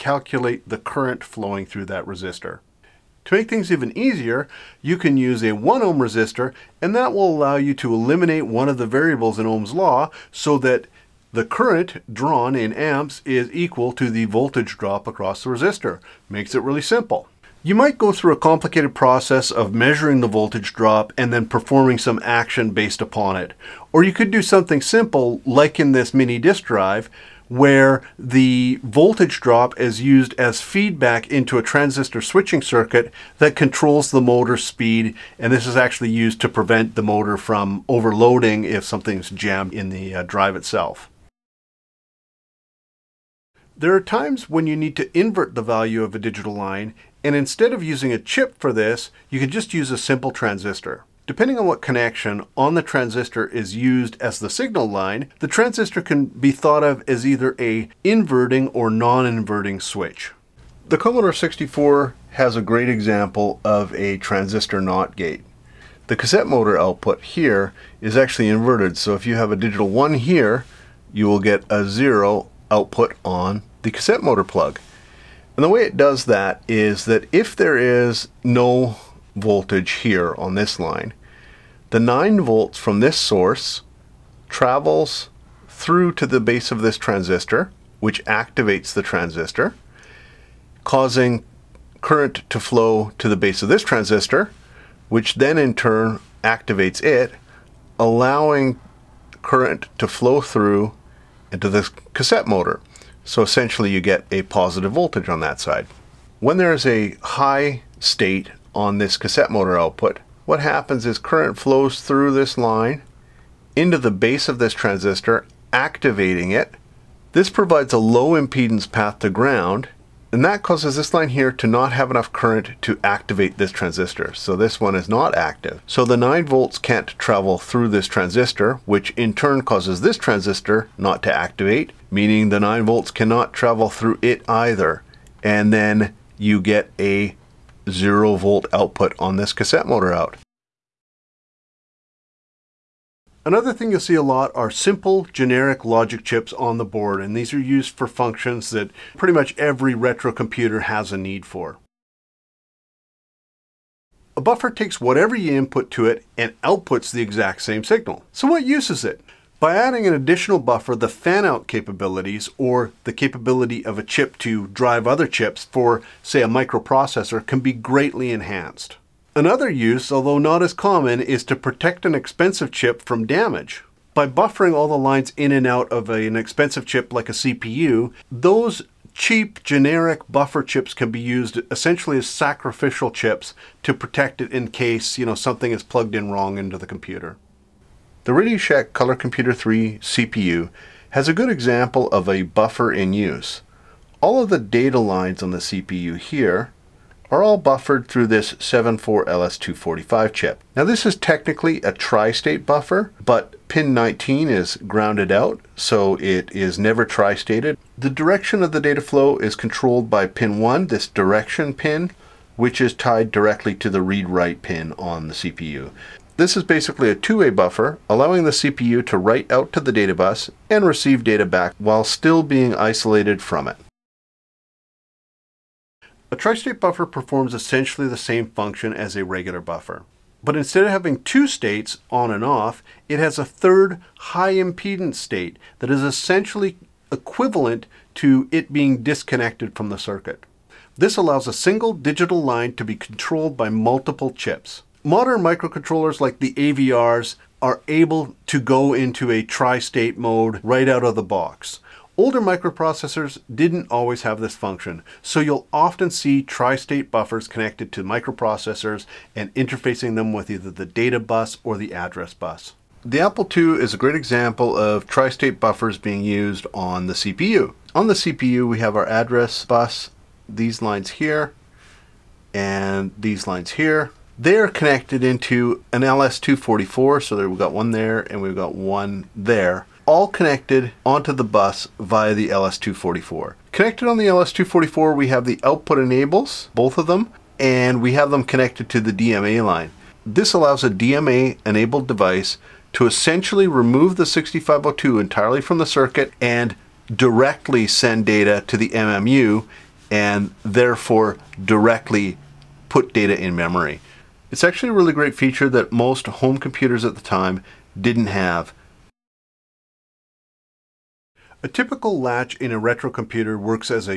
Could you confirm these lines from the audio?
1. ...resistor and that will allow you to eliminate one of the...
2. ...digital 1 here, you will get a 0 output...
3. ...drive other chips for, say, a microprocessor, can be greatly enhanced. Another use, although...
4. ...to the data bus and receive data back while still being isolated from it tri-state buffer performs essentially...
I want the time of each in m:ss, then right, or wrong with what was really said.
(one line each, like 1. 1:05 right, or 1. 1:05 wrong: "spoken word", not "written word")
1. 0:05 right
2. 1:09 right
3. 2:44 right
4. 3:39 right.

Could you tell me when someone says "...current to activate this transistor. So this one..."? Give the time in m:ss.
2:02.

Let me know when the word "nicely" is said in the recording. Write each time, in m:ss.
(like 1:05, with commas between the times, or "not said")
not said.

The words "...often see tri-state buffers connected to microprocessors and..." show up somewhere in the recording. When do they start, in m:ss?
4:15.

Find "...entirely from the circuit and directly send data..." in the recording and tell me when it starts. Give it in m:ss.
4:55.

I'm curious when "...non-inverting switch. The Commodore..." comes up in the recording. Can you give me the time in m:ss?
0:58.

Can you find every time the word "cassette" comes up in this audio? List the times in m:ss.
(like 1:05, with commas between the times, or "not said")
1:06, 1:13, 1:42, 1:49, 2:19.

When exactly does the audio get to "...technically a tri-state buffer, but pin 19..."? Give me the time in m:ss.
3:21.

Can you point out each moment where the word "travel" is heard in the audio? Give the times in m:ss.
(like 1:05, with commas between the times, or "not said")
1:24, 2:07, 2:13.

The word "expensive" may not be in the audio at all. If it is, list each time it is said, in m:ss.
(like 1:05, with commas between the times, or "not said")
2:52, 2:56.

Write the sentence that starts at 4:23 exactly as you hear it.
The Apple II is a great example of tri-state buffers being used on the CPU.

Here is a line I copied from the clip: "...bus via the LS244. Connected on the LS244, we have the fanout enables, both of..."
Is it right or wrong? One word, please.
wrong.